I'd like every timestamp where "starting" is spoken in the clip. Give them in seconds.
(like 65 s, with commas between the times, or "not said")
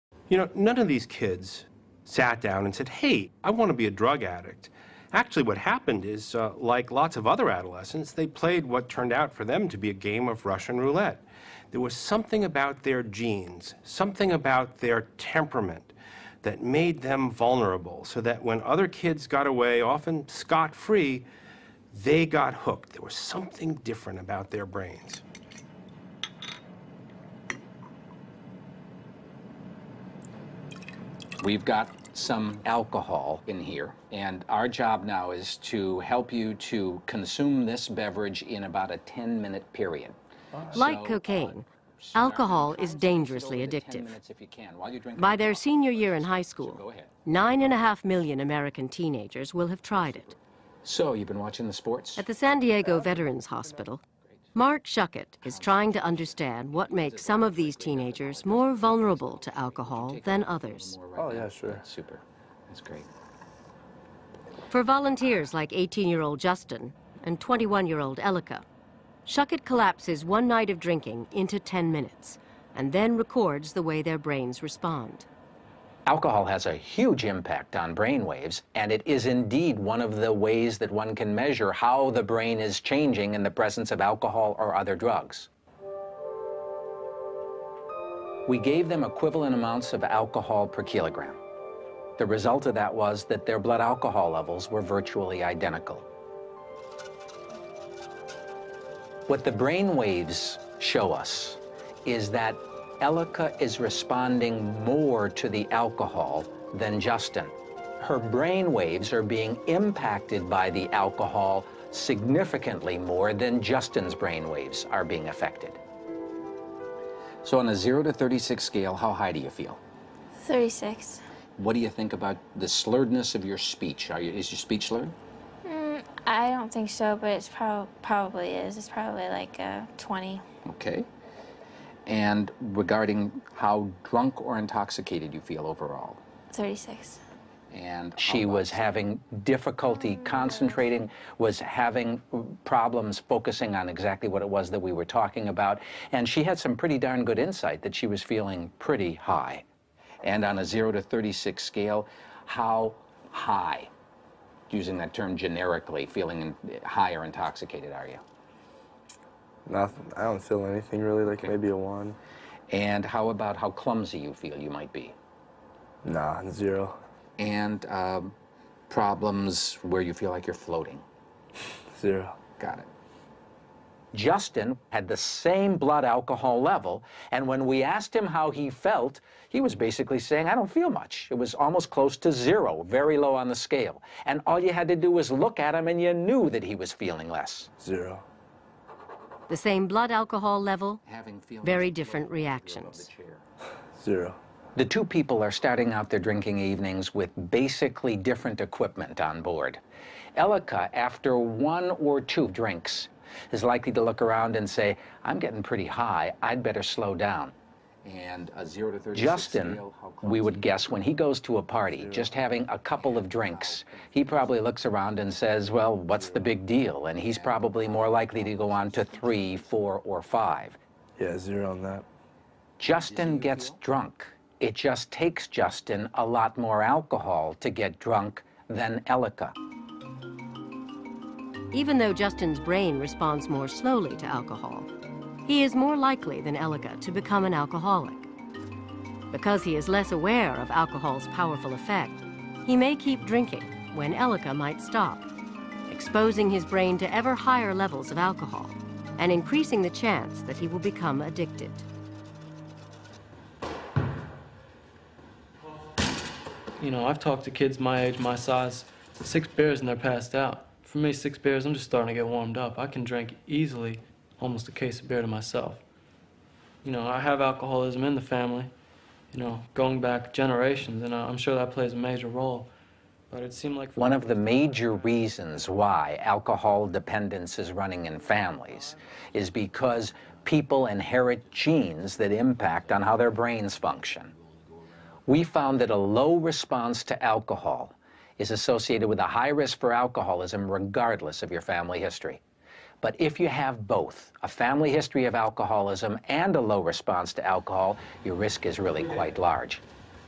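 195 s, 261 s.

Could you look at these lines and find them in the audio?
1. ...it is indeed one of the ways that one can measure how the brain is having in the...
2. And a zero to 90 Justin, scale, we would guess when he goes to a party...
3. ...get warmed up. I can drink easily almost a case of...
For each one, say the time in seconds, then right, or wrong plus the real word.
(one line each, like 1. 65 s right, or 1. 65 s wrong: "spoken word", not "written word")
1. 78 s wrong: "changing", not "having"
2. 208 s wrong: "30", not "90"
3. 262 s right.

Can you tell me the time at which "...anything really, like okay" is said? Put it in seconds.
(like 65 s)
160 s.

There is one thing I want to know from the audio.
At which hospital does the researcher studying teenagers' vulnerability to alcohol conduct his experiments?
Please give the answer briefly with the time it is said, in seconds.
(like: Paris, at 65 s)
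San Diego Veterans Hospital, at 52 s.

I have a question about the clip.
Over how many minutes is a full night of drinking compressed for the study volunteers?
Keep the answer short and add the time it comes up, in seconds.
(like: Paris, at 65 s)
10 minutes, at 71 s.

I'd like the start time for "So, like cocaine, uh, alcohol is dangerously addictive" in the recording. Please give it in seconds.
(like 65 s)
40 s.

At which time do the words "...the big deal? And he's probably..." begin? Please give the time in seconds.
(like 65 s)
216 s.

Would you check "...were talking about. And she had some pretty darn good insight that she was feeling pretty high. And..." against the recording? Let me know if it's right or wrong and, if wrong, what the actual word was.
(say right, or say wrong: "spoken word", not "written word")
right.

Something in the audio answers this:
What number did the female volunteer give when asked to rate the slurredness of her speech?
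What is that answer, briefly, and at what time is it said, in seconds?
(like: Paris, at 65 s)
20, at 129 s.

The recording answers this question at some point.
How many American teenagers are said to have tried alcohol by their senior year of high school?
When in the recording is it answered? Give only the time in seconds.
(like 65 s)
47 s.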